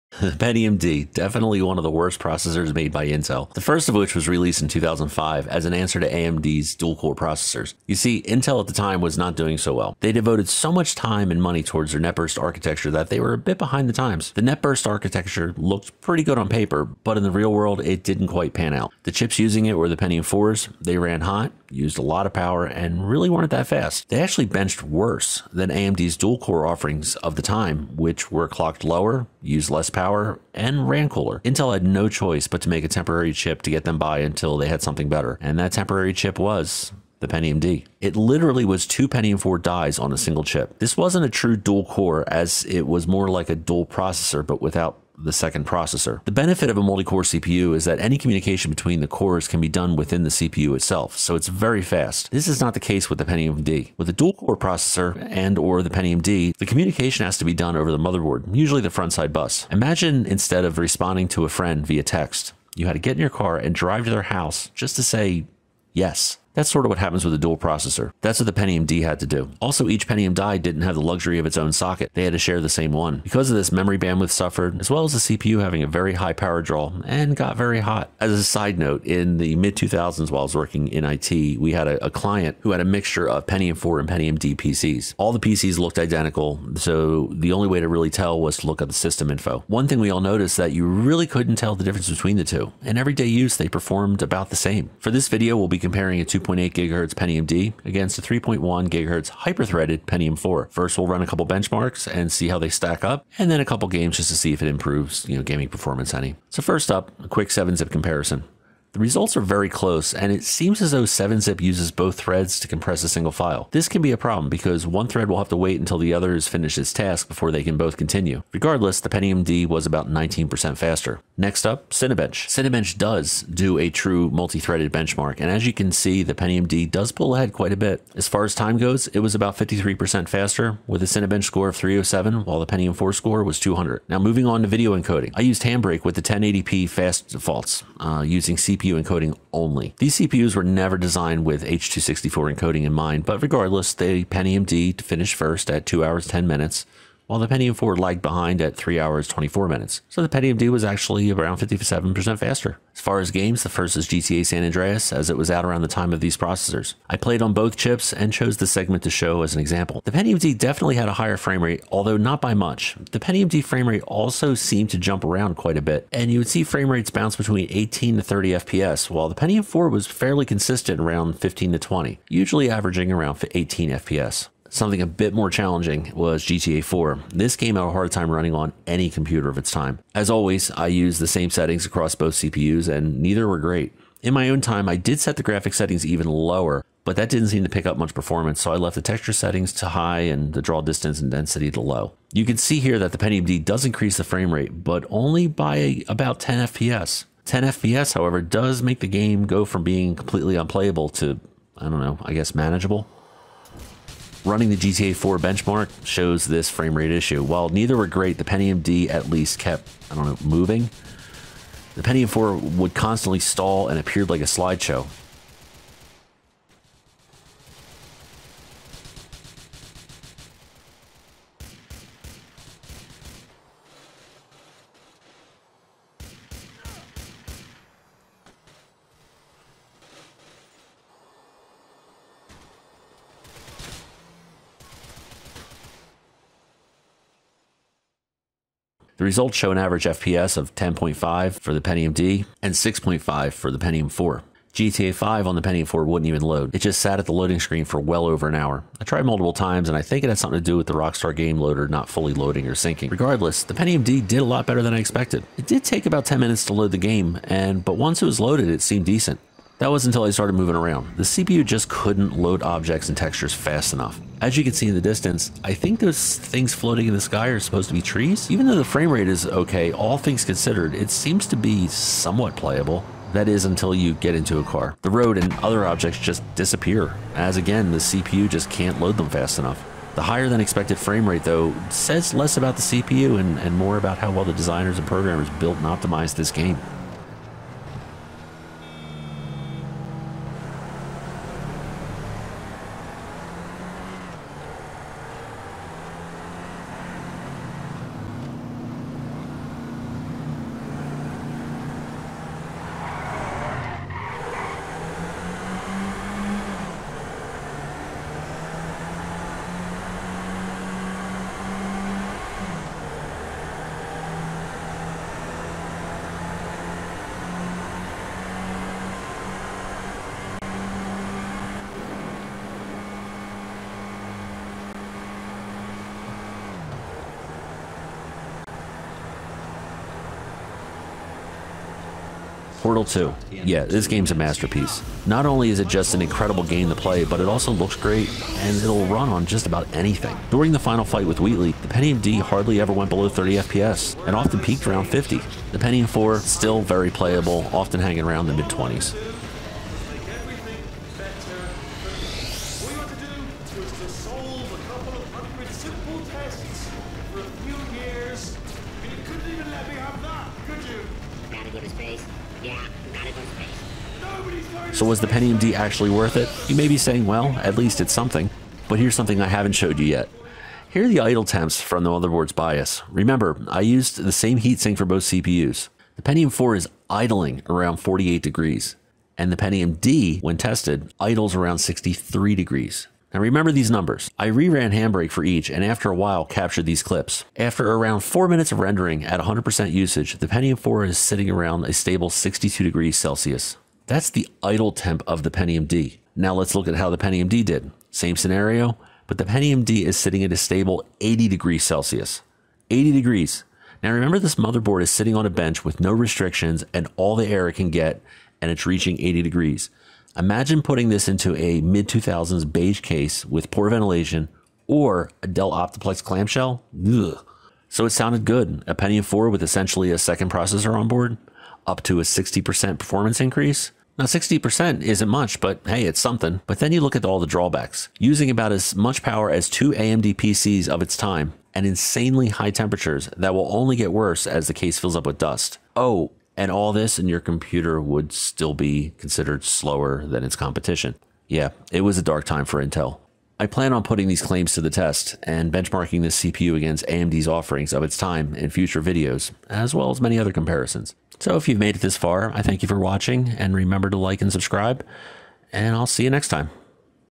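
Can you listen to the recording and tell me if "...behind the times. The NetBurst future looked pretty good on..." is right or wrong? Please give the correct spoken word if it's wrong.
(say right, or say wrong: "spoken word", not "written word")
wrong: "architecture", not "future".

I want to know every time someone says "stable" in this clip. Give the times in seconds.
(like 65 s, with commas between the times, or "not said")
391 s, 400 s.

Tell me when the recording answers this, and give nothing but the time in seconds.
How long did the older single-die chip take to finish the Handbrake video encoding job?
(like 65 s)
148 s.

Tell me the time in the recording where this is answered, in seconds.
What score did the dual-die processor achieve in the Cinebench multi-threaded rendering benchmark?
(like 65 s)
131 s.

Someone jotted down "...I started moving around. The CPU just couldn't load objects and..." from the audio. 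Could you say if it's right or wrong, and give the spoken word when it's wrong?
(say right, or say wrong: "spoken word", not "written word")
right.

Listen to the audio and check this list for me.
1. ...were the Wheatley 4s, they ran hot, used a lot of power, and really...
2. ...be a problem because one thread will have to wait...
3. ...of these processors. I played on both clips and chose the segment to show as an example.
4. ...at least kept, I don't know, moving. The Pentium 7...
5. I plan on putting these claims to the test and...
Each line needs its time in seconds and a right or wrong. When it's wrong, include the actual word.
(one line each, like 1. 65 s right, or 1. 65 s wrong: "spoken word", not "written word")
1. 19 s wrong: "Pentium", not "Wheatley"
2. 114 s right
3. 156 s wrong: "chips", not "clips"
4. 209 s wrong: "4", not "7"
5. 443 s right.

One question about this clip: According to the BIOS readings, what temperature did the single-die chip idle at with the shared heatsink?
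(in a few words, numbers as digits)
48 degrees.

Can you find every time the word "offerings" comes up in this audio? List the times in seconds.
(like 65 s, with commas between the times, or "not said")
26 s, 447 s.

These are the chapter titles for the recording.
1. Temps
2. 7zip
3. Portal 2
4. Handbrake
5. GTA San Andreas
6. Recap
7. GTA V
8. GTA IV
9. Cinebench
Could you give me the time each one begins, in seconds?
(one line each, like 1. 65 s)
1. 372 s
2. 108 s
3. 332 s
4. 133 s
5. 152 s
6. 402 s
7. 242 s
8. 177 s
9. 122 s.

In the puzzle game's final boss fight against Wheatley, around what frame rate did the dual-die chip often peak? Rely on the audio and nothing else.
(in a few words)
50.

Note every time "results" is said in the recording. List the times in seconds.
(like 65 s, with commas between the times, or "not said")
108 s, 239 s.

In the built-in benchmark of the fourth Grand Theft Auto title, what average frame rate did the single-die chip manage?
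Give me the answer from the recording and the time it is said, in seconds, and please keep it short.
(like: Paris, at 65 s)
6.5, at 242 s.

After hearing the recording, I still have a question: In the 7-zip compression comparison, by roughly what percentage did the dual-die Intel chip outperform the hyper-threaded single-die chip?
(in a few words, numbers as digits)
19%.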